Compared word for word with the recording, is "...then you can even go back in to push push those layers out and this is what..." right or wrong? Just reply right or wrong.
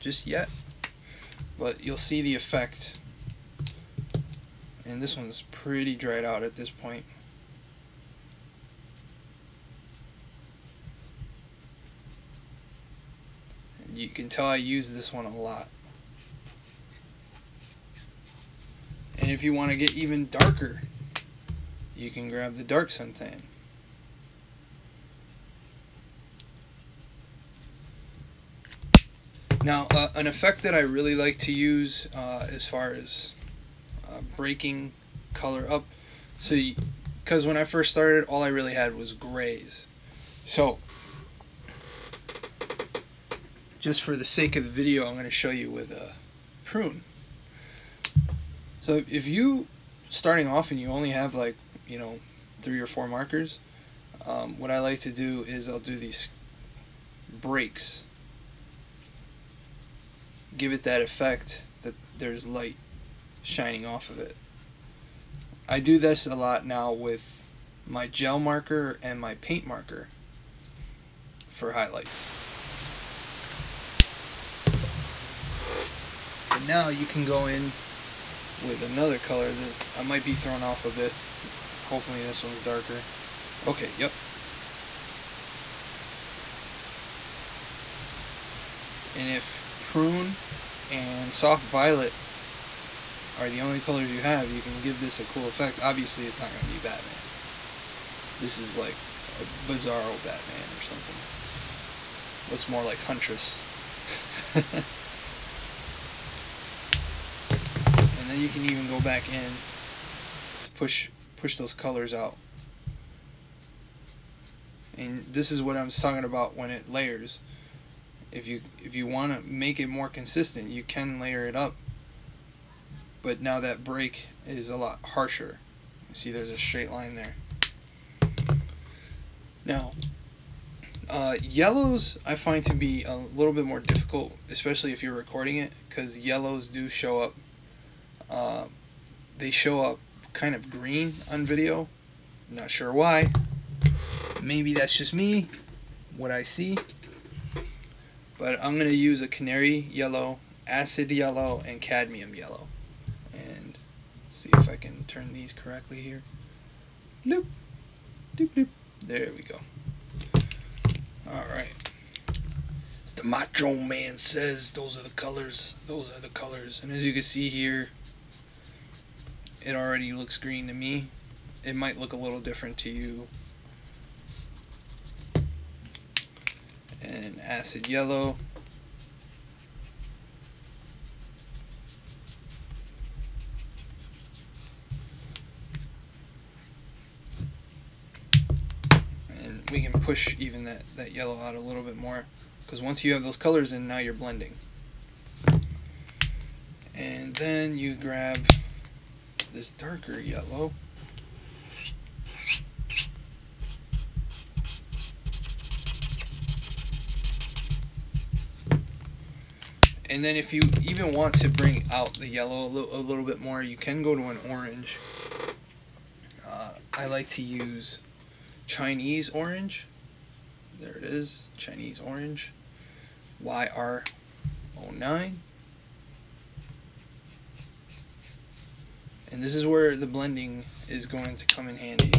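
wrong.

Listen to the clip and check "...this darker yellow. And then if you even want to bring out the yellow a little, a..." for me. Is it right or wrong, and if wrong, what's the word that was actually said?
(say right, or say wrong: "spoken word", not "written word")
right.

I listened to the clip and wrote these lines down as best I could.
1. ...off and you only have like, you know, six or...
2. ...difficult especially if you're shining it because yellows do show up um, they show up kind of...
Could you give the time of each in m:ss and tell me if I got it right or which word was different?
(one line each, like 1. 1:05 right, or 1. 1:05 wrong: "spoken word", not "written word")
1. 0:50 wrong: "three", not "six"
2. 2:13 wrong: "recording", not "shining".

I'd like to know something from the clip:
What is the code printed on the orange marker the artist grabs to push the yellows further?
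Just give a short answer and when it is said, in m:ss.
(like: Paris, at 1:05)
YR09, at 3:43.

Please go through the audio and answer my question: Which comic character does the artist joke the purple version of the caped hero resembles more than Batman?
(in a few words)
Huntress.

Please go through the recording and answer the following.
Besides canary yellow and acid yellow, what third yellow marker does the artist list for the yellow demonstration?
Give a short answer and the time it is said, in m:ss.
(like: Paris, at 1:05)
Cadmium yellow, at 2:31.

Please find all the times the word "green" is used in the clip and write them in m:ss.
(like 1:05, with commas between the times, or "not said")
2:20, 2:50.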